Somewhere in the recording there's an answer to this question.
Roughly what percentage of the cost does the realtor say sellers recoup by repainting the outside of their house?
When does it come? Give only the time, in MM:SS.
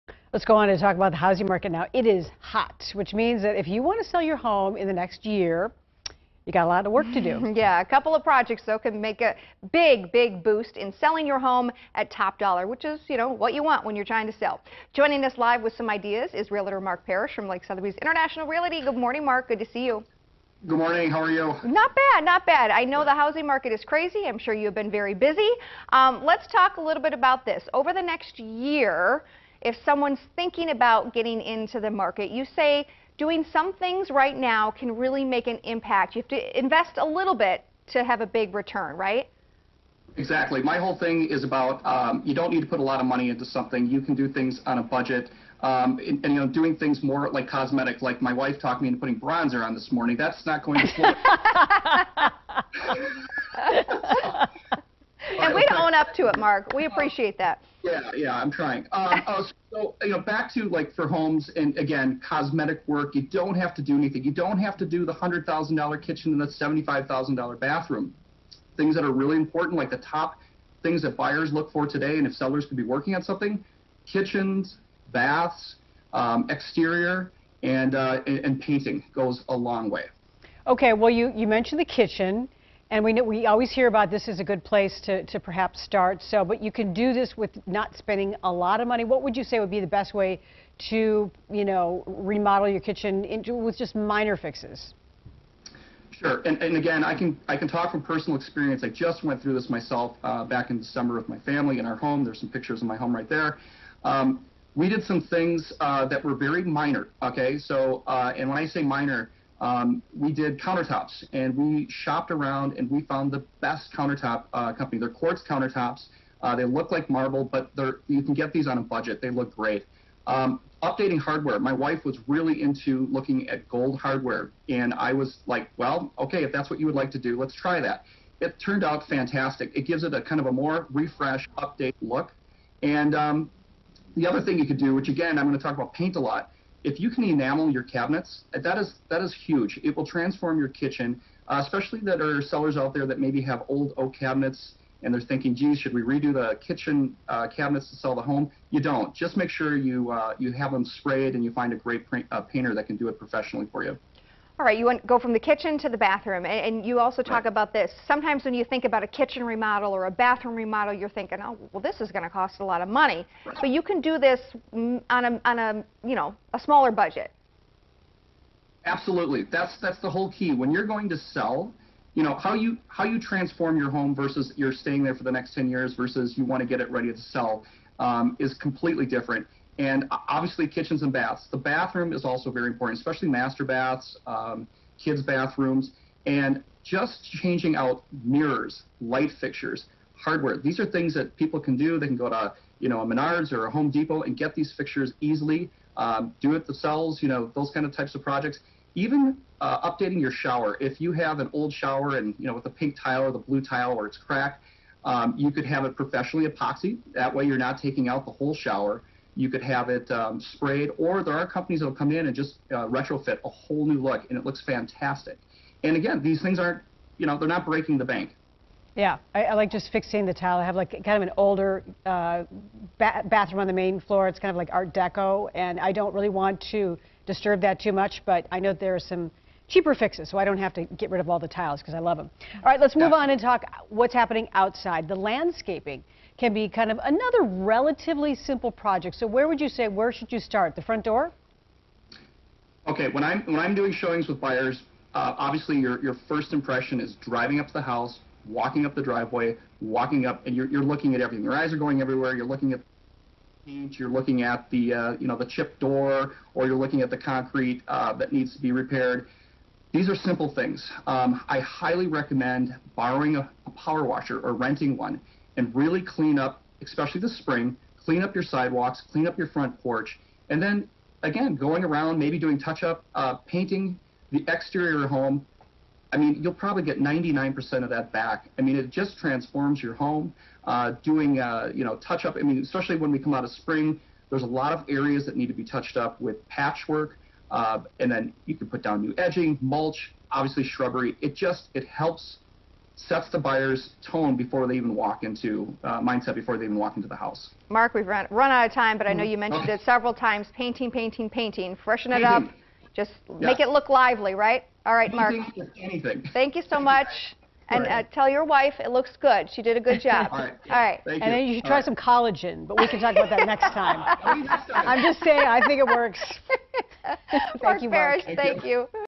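04:36.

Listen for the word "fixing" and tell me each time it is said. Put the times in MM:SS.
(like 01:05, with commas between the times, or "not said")
03:39.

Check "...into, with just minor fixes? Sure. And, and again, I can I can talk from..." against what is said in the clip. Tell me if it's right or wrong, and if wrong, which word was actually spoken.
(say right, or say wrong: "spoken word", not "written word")
right.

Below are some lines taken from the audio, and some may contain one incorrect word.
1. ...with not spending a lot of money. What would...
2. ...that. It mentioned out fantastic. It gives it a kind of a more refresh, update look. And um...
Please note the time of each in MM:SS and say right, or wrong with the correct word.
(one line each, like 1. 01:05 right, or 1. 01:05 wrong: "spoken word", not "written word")
1. 01:27 right
2. 02:07 wrong: "turned", not "mentioned".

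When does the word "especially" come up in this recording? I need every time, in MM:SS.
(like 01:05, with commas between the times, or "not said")
02:21, 03:02, 04:26, 04:42.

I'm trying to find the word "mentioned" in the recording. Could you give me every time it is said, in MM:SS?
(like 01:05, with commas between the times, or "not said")
01:21, 04:59.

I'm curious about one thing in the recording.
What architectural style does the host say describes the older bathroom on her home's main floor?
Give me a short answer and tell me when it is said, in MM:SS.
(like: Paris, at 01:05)
Art Deco, at 03:44.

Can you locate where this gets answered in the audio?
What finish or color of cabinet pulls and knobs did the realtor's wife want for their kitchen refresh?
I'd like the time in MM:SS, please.
02:03.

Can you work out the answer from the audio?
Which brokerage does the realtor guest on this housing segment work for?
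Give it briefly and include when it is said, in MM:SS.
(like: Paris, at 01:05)
Lakes Sotheby's International Realty, at 00:17.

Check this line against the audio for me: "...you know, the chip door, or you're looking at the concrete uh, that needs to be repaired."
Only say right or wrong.
right.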